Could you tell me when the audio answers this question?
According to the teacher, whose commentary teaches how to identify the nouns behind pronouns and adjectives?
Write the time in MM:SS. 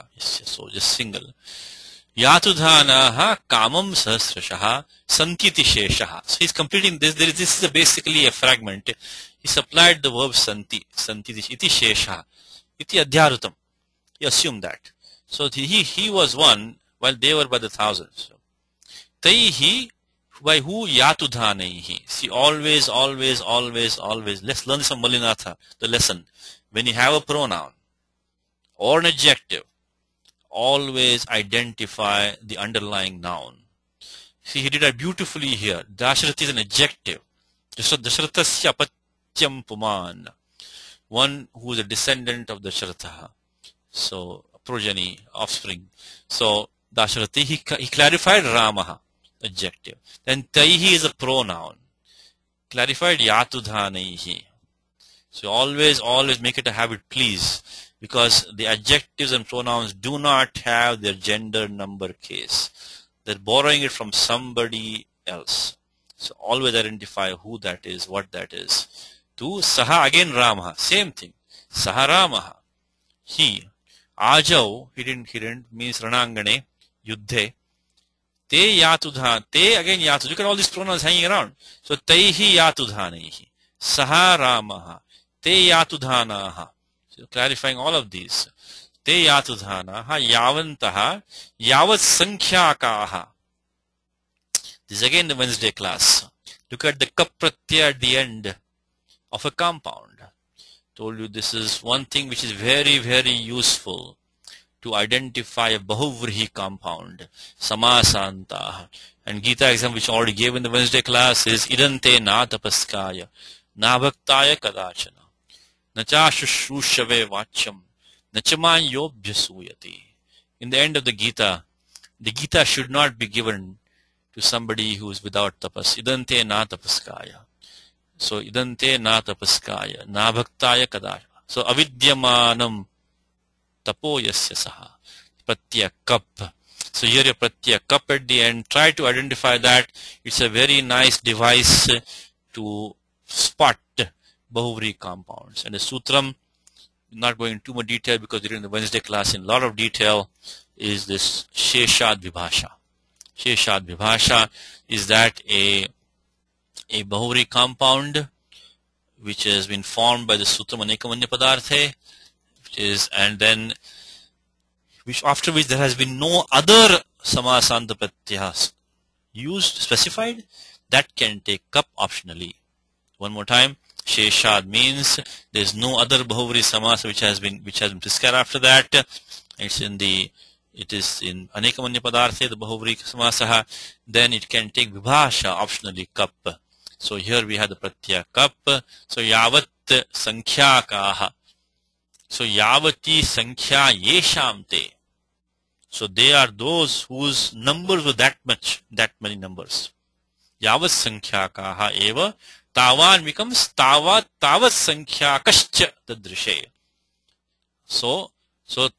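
00:25.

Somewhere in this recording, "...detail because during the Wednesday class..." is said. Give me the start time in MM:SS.
02:27.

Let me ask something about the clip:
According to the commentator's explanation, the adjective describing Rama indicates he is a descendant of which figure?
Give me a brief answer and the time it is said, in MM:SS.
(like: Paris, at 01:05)
Dashratha, at 00:42.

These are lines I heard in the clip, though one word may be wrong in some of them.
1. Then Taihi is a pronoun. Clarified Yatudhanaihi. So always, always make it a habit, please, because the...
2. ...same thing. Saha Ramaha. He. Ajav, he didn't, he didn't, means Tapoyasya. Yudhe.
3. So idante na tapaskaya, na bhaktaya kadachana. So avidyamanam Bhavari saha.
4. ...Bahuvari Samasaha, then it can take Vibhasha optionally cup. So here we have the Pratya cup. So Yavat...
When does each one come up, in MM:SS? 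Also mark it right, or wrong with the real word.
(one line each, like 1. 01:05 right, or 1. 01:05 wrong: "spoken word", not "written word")
1. 00:50 right
2. 01:10 wrong: "Ranangane", not "Tapoyasya"
3. 02:08 wrong: "Tapoyasya", not "Bhavari"
4. 03:02 right.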